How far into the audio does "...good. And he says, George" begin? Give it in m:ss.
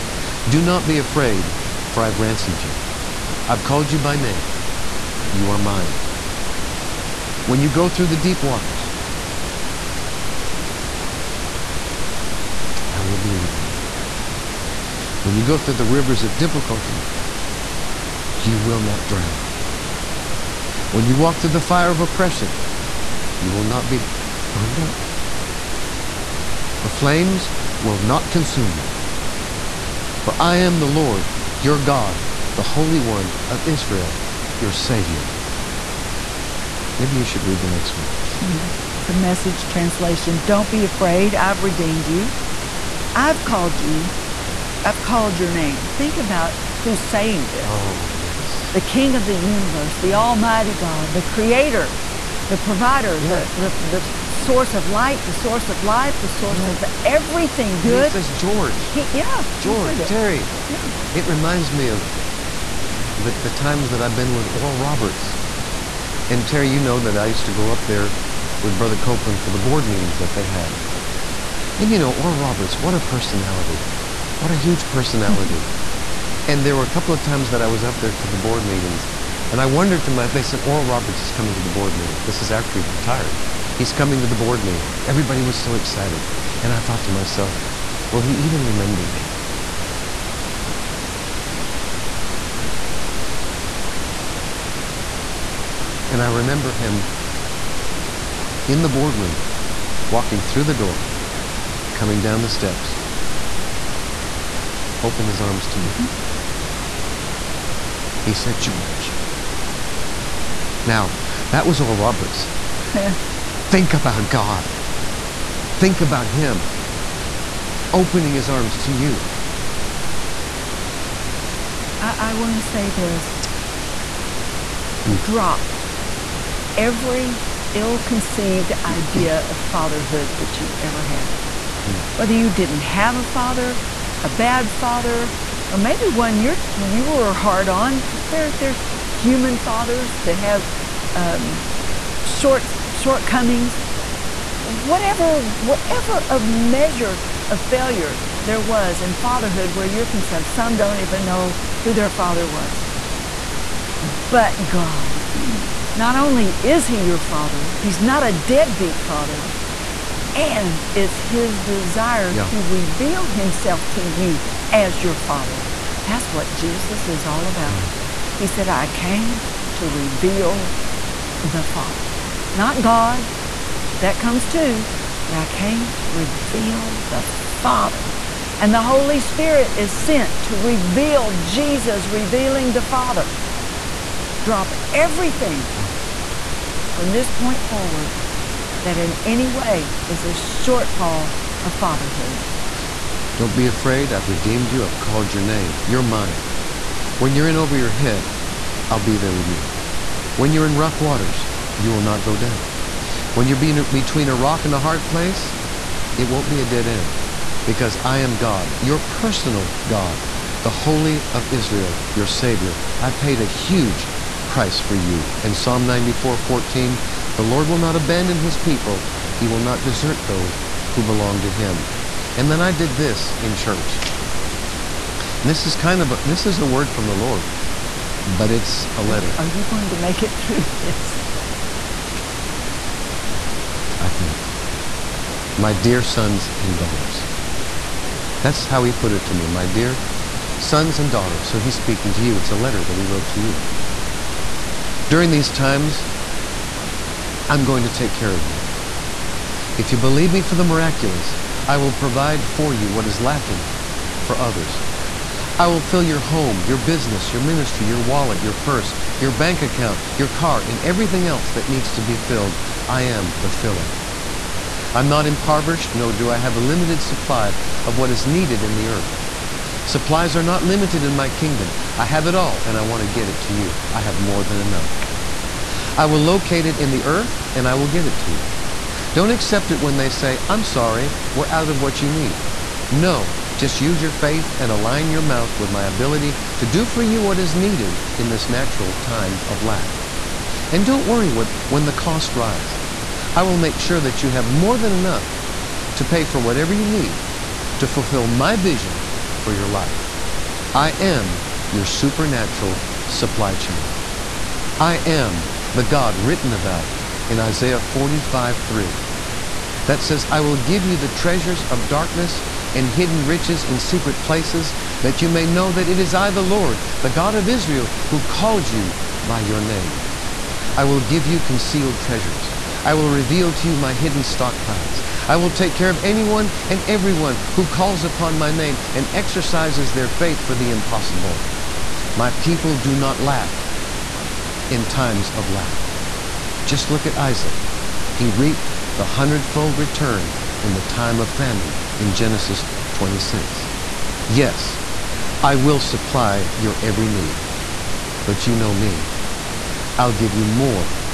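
0:57.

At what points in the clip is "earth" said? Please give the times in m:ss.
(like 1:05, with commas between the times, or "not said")
4:28, 4:37.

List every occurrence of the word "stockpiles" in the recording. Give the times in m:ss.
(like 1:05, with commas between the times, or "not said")
5:24.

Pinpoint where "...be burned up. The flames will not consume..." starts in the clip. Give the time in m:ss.
0:23.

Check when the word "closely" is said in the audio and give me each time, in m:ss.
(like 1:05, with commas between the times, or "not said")
not said.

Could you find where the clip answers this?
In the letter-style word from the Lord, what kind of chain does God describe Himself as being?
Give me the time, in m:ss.
5:01.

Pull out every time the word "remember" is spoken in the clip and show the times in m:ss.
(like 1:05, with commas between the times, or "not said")
1:28, 1:36.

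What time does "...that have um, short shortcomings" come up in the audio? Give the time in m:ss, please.
2:20.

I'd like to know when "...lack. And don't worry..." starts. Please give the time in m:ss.
4:49.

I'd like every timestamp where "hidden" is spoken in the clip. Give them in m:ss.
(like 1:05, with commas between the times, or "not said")
5:12, 5:23.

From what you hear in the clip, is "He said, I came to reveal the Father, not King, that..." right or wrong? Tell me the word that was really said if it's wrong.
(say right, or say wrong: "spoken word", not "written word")
wrong: "God", not "King".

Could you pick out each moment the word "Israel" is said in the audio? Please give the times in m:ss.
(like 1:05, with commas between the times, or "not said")
0:33, 3:31, 5:17.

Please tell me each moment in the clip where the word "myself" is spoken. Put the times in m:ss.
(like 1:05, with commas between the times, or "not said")
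1:27.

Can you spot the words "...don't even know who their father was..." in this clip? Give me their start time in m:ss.
2:30.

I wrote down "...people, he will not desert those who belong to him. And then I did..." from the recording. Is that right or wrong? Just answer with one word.
right.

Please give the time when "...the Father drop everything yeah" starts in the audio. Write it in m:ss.
3:02.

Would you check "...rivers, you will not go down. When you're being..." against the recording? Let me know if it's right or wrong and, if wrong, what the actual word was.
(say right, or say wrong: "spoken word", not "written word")
wrong: "waters", not "rivers".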